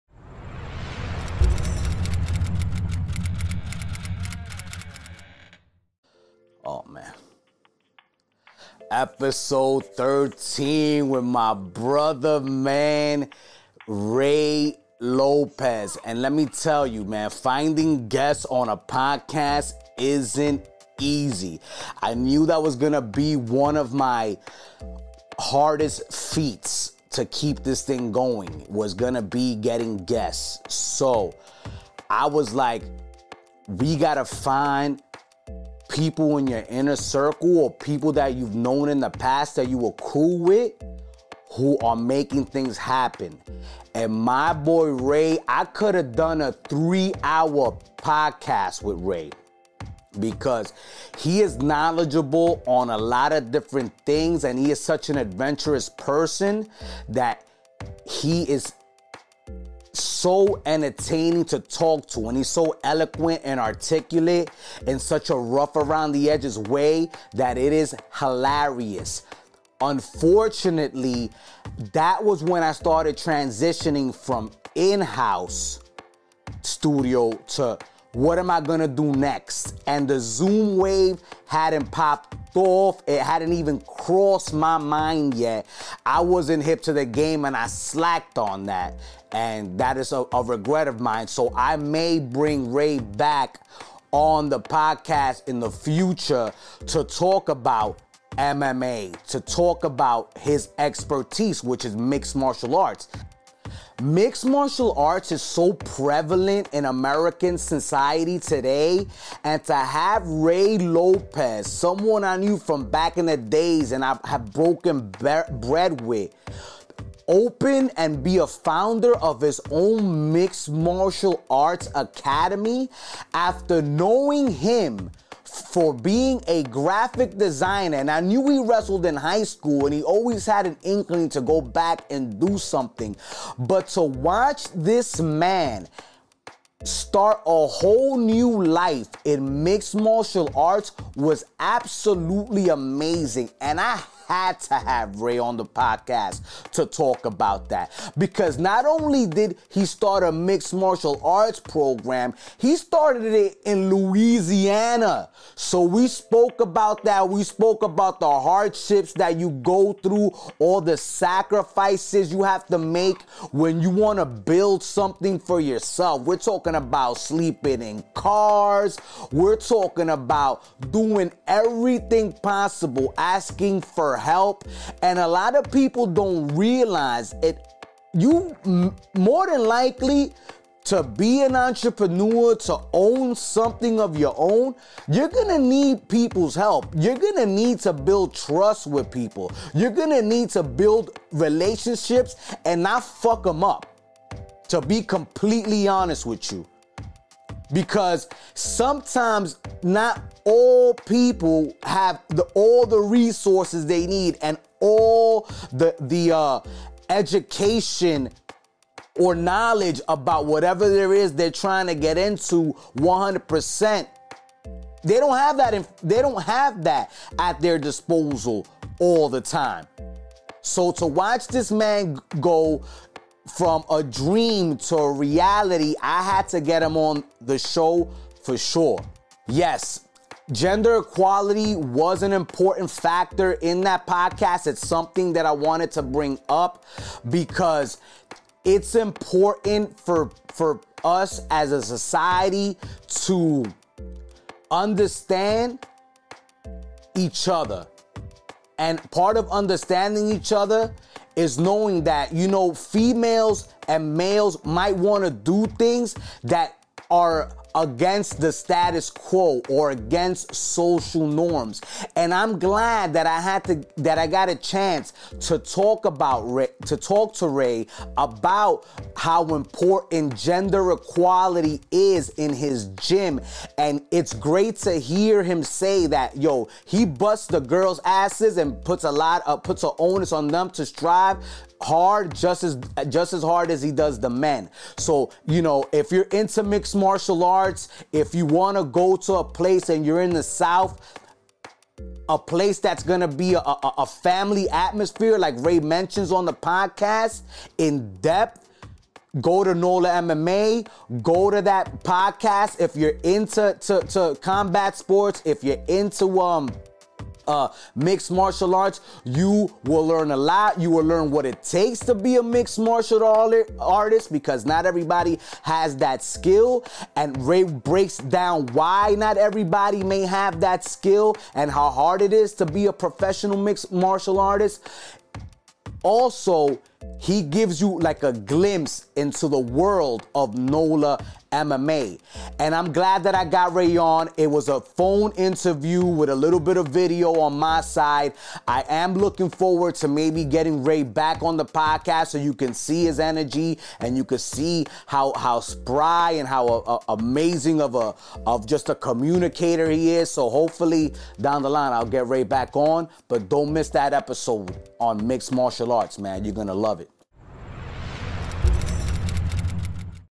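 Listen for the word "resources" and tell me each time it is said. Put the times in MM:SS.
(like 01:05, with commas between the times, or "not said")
03:22.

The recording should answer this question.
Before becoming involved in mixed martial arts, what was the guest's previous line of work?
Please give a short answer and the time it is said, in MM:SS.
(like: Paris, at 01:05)
graphic designer, at 02:06.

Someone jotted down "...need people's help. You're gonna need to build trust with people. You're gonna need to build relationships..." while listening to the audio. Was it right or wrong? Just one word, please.
right.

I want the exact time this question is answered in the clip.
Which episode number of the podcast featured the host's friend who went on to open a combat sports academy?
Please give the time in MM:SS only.
00:08.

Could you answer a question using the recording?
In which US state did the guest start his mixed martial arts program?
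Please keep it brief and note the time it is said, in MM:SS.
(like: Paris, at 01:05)
Louisiana, at 02:33.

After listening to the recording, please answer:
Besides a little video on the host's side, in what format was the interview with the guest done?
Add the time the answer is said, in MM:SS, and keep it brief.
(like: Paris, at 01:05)
phone interview, at 05:34.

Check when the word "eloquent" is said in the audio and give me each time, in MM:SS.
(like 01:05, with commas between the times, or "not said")
01:02.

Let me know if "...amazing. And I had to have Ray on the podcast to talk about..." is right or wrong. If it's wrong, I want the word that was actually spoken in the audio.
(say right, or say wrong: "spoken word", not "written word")
right.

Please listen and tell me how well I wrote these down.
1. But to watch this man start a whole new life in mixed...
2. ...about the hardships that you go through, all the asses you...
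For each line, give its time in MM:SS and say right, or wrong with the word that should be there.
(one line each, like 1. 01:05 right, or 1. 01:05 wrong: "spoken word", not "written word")
1. 02:13 right
2. 02:37 wrong: "sacrifices", not "asses".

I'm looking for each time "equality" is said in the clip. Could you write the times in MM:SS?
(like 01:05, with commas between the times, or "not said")
03:50, 04:30.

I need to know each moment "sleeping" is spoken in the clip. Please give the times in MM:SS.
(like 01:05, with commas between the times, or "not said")
02:47.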